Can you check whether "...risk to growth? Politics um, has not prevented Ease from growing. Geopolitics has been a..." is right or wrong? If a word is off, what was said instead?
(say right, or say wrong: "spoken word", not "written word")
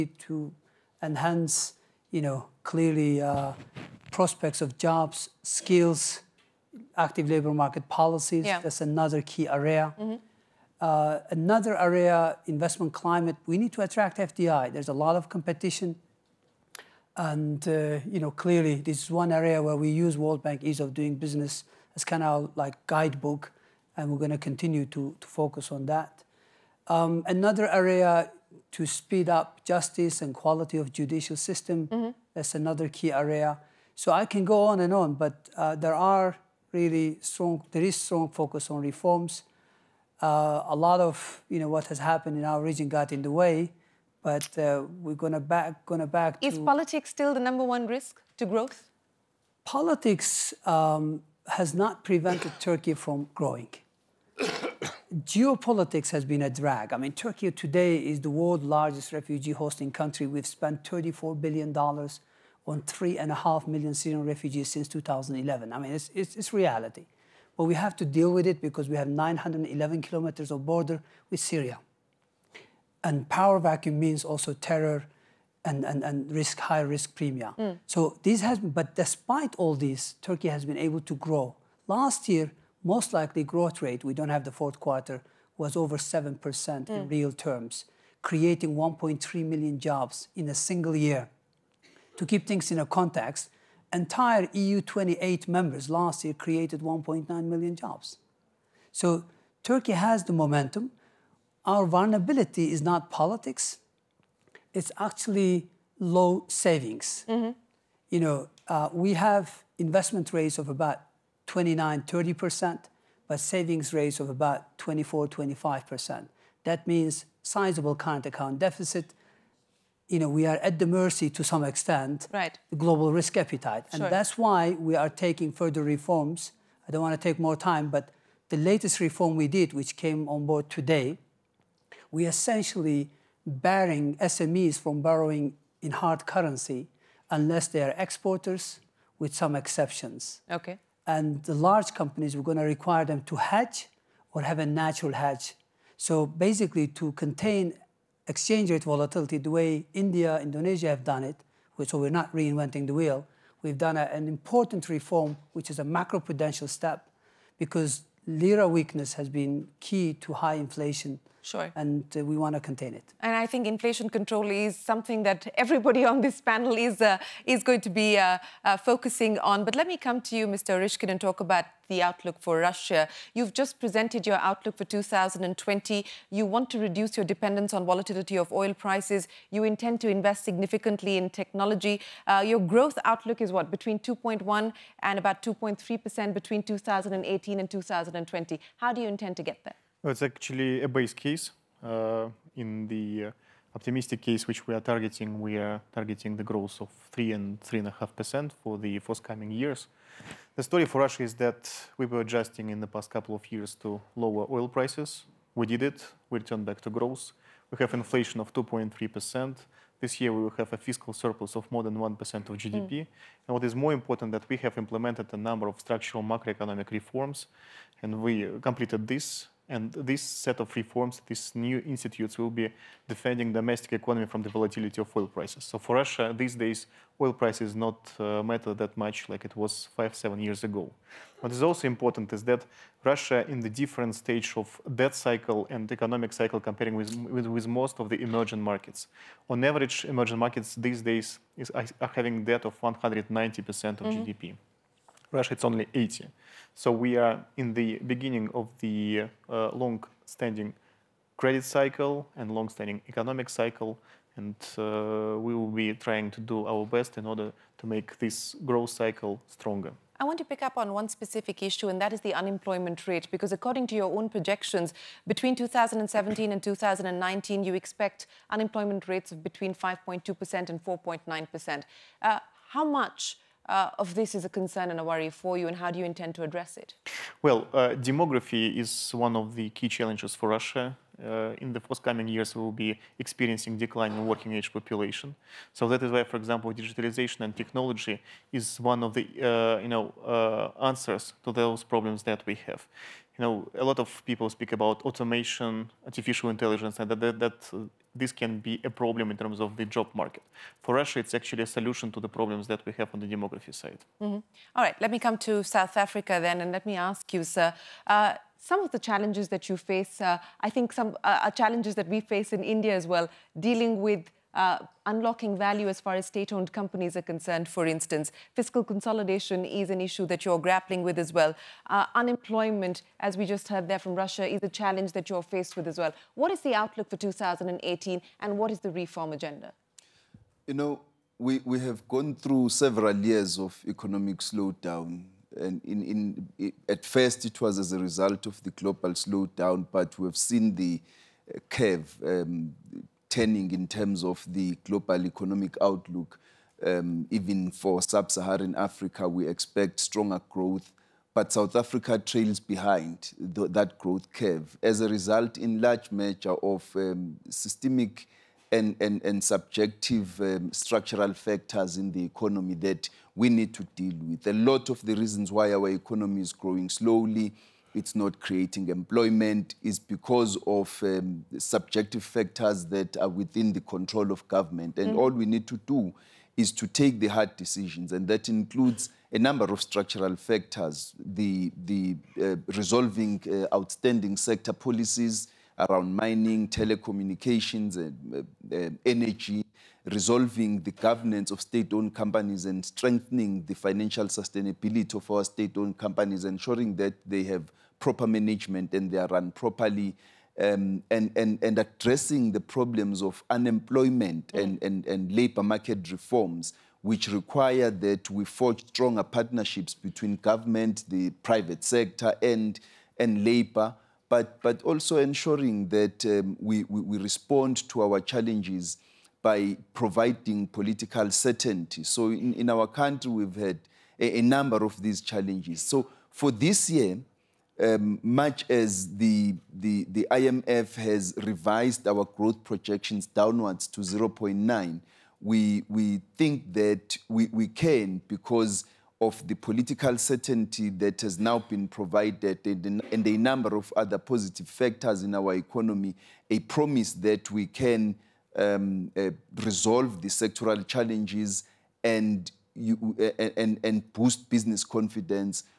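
wrong: "Turkey", not "Ease".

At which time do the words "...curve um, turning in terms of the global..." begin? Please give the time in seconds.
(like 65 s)
341 s.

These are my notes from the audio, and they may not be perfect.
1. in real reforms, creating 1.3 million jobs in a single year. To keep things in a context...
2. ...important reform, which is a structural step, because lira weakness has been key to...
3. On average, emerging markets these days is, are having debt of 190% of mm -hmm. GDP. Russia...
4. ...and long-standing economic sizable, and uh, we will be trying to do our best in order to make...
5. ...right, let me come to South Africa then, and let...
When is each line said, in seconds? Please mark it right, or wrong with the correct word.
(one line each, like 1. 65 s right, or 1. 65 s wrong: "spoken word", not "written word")
1. 86 s wrong: "terms", not "reforms"
2. 154 s wrong: "macroprudential", not "structural"
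3. 239 s right
4. 252 s wrong: "cycle", not "sizable"
5. 304 s right.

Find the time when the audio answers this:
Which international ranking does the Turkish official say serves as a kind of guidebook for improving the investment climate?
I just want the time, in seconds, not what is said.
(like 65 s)
20 s.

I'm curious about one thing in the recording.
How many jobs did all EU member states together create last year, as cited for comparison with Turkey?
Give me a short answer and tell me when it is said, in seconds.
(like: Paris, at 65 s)
1.9 million, at 96 s.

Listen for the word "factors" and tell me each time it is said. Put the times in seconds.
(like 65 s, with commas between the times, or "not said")
361 s, 372 s, 380 s, 444 s.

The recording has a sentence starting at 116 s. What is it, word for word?
That means sizable current account deficit, you know, we are at the mercy to some extent right.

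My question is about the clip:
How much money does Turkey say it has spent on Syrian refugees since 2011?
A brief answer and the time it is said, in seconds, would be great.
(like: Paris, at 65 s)
34 billion dollars, at 60 s.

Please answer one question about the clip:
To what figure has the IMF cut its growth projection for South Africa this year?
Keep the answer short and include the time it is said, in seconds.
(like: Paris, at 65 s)
0.9, at 434 s.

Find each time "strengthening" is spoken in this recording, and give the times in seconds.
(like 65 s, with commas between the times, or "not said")
392 s.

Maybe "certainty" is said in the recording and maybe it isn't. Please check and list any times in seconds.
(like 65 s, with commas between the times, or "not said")
421 s, 440 s.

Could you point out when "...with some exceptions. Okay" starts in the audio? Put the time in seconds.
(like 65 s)
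139 s.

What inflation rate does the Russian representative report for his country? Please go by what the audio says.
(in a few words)
2.3 percent.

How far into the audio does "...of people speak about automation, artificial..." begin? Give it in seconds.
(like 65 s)
293 s.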